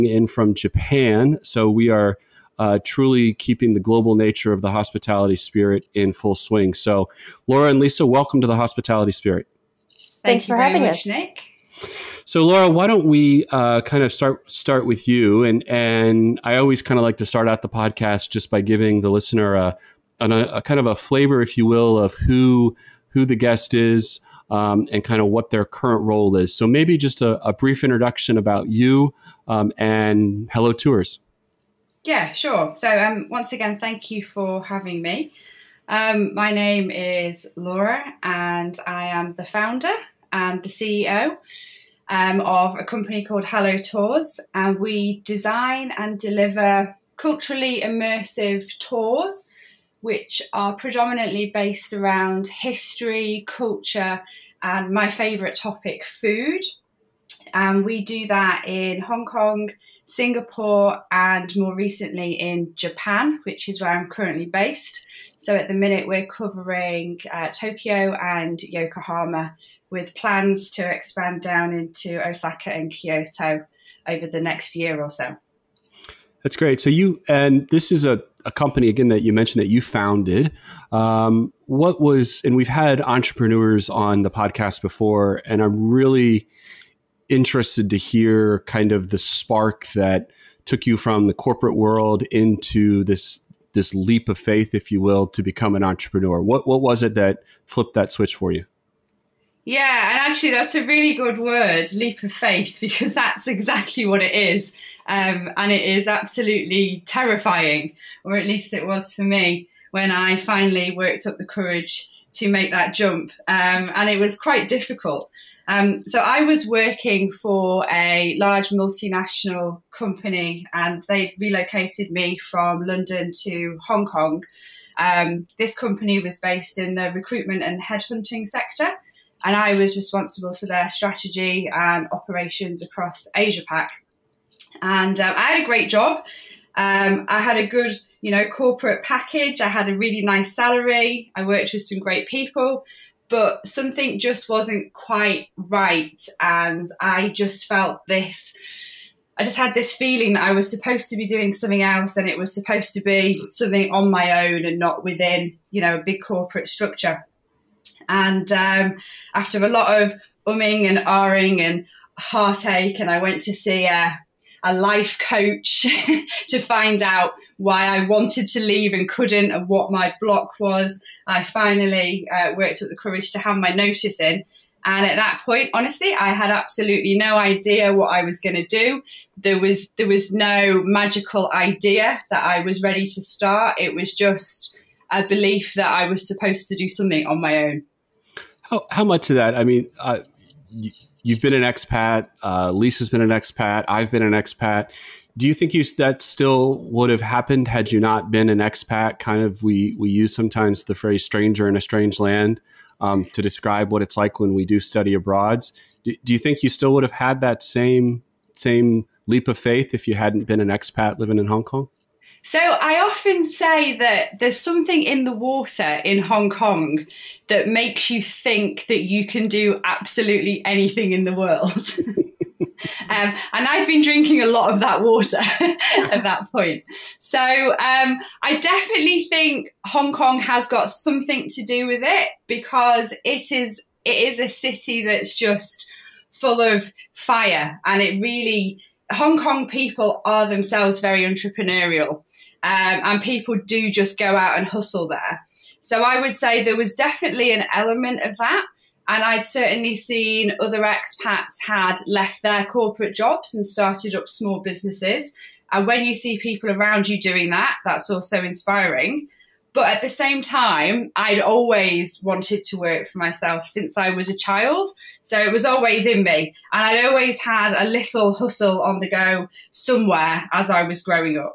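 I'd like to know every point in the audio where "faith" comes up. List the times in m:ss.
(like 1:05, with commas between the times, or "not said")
1:34, 1:42, 3:29.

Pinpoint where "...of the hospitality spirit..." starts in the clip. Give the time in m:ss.
0:04.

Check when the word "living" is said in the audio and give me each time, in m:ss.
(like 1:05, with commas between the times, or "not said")
3:31.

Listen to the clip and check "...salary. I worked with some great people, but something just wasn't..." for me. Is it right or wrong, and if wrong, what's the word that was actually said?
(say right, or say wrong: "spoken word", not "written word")
right.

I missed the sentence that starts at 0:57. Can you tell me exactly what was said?
And we do that in Hong Kong, Singapore, and more recently in Japan, which is where I'm currently based.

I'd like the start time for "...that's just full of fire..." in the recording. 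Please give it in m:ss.
3:55.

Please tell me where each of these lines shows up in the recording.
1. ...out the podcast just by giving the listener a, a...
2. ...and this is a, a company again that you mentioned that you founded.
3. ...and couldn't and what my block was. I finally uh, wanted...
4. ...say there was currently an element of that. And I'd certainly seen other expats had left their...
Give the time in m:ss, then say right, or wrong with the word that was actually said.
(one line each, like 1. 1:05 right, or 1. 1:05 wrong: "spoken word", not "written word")
1. 0:17 right
2. 1:17 right
3. 2:48 wrong: "worked", not "wanted"
4. 4:06 wrong: "definitely", not "currently".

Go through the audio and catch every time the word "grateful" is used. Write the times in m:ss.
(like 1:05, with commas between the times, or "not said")
not said.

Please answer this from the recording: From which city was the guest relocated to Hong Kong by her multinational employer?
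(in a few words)
London.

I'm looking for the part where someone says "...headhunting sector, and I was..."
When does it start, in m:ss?
2:07.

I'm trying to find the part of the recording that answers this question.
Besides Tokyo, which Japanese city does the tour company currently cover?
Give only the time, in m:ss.
1:08.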